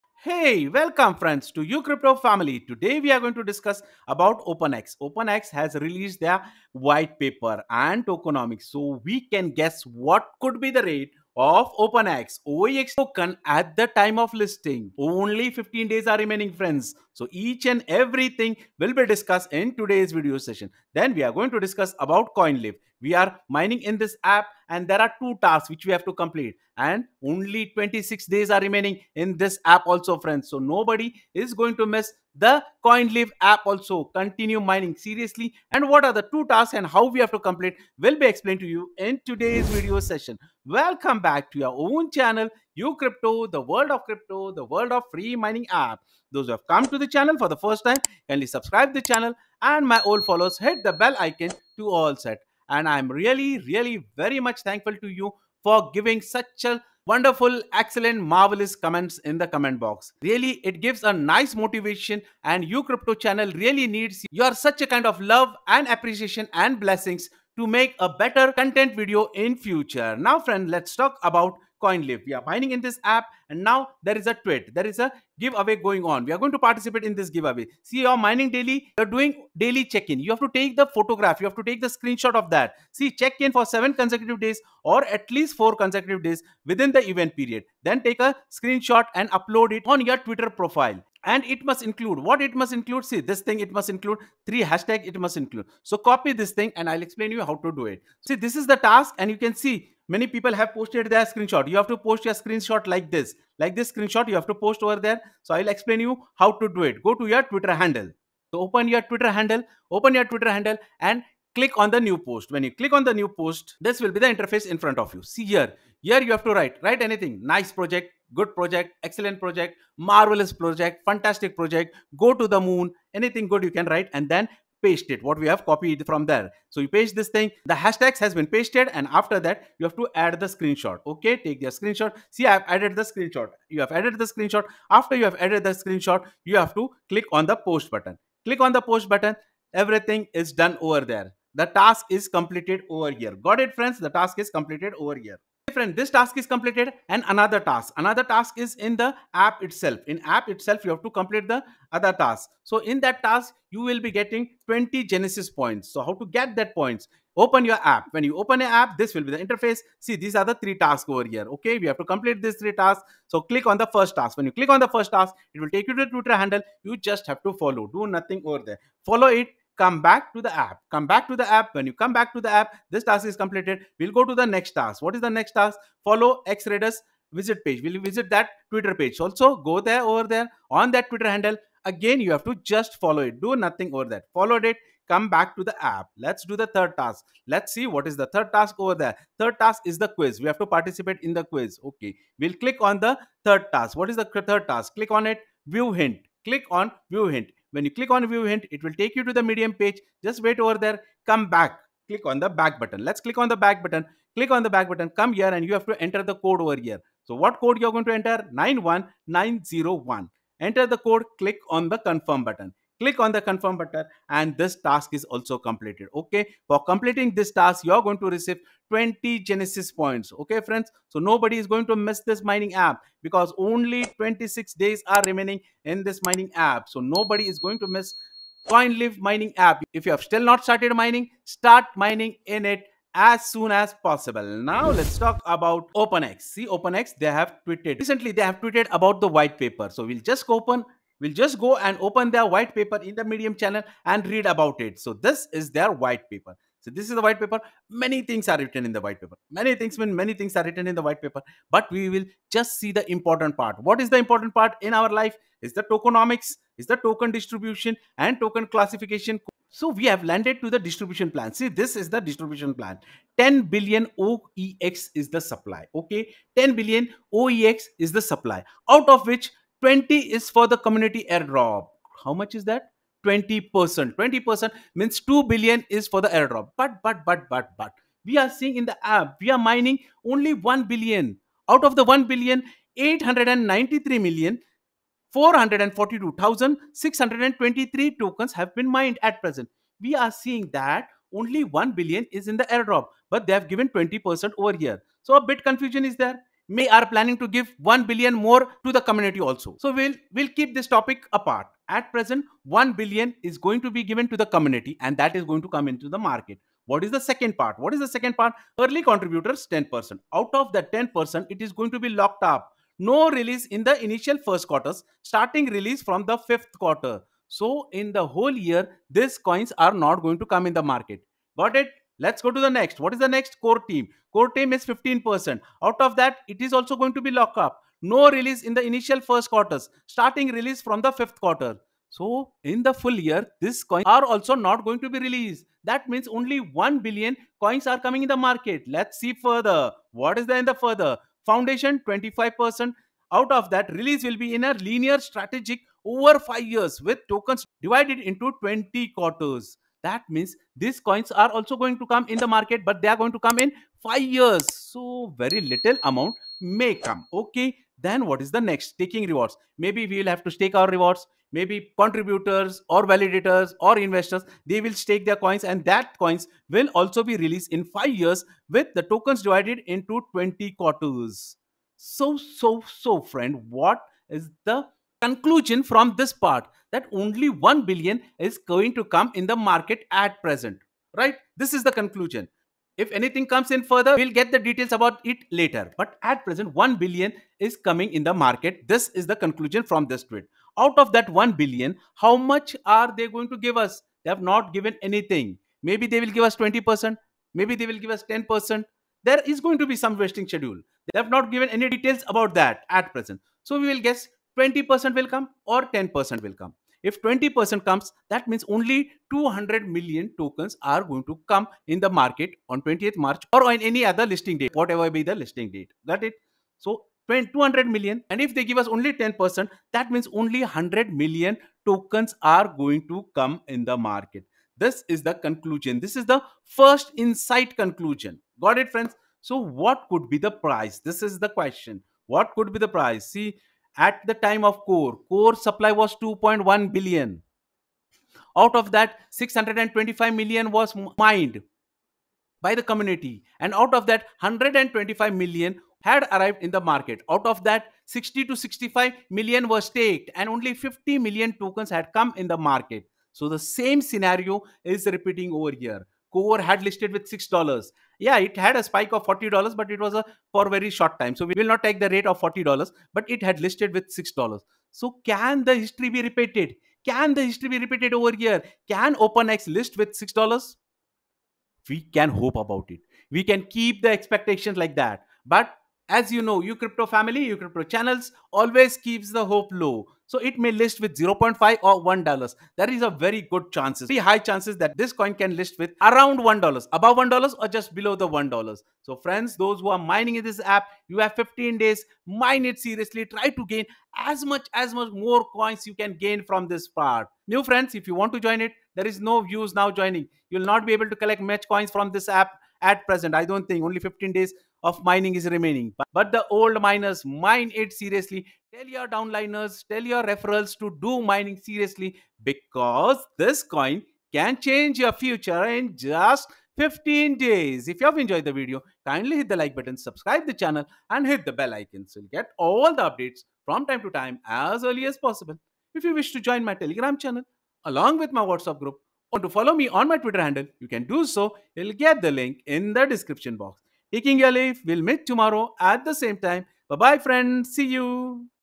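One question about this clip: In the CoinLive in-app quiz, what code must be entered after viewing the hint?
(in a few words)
91901.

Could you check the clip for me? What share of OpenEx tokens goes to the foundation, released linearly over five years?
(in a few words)
25%.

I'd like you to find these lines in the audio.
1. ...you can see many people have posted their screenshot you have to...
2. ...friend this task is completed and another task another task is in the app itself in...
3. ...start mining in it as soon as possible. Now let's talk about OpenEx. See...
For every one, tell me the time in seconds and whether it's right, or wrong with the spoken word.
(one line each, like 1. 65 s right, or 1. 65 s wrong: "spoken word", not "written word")
1. 99 s right
2. 145 s right
3. 231 s right.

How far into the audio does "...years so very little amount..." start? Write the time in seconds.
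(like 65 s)
354 s.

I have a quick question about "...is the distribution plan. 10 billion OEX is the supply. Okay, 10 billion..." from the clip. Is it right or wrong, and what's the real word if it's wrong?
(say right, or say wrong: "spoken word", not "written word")
right.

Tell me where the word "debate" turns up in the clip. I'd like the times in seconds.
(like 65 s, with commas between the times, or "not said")
not said.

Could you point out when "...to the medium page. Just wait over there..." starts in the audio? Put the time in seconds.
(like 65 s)
199 s.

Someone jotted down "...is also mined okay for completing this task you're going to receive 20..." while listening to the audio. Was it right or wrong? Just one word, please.
wrong.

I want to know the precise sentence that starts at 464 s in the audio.
So can the history be repeated?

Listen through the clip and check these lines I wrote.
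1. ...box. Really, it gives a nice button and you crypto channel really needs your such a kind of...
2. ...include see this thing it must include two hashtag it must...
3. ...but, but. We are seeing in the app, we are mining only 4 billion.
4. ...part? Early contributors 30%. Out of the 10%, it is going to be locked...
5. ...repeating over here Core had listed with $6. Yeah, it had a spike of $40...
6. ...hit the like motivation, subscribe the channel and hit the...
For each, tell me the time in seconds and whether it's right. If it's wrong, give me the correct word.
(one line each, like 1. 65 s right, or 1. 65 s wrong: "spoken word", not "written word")
1. 59 s wrong: "motivation", not "button"
2. 92 s wrong: "three", not "two"
3. 277 s wrong: "1", not "4"
4. 308 s wrong: "10", not "30"
5. 455 s right
6. 519 s wrong: "button", not "motivation".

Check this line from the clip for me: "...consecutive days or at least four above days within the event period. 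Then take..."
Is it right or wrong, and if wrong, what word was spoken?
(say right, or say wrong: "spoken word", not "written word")
wrong: "consecutive", not "above".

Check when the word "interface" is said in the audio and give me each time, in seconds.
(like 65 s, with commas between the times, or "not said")
114 s, 159 s.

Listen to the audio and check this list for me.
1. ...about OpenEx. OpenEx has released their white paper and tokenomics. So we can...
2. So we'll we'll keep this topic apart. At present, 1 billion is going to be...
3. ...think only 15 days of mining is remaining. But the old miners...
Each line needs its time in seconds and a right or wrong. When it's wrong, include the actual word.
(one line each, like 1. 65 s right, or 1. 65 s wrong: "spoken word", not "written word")
1. 4 s right
2. 299 s right
3. 503 s right.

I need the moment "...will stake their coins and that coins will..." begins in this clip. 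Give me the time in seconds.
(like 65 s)
364 s.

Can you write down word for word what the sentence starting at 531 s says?
You'll get the link in the description box.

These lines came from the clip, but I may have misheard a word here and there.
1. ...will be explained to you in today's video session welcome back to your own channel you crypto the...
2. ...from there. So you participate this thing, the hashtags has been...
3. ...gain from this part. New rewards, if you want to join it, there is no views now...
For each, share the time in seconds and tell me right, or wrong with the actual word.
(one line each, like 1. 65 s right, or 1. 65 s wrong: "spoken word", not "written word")
1. 37 s right
2. 126 s wrong: "paste", not "participate"
3. 496 s wrong: "friends", not "rewards".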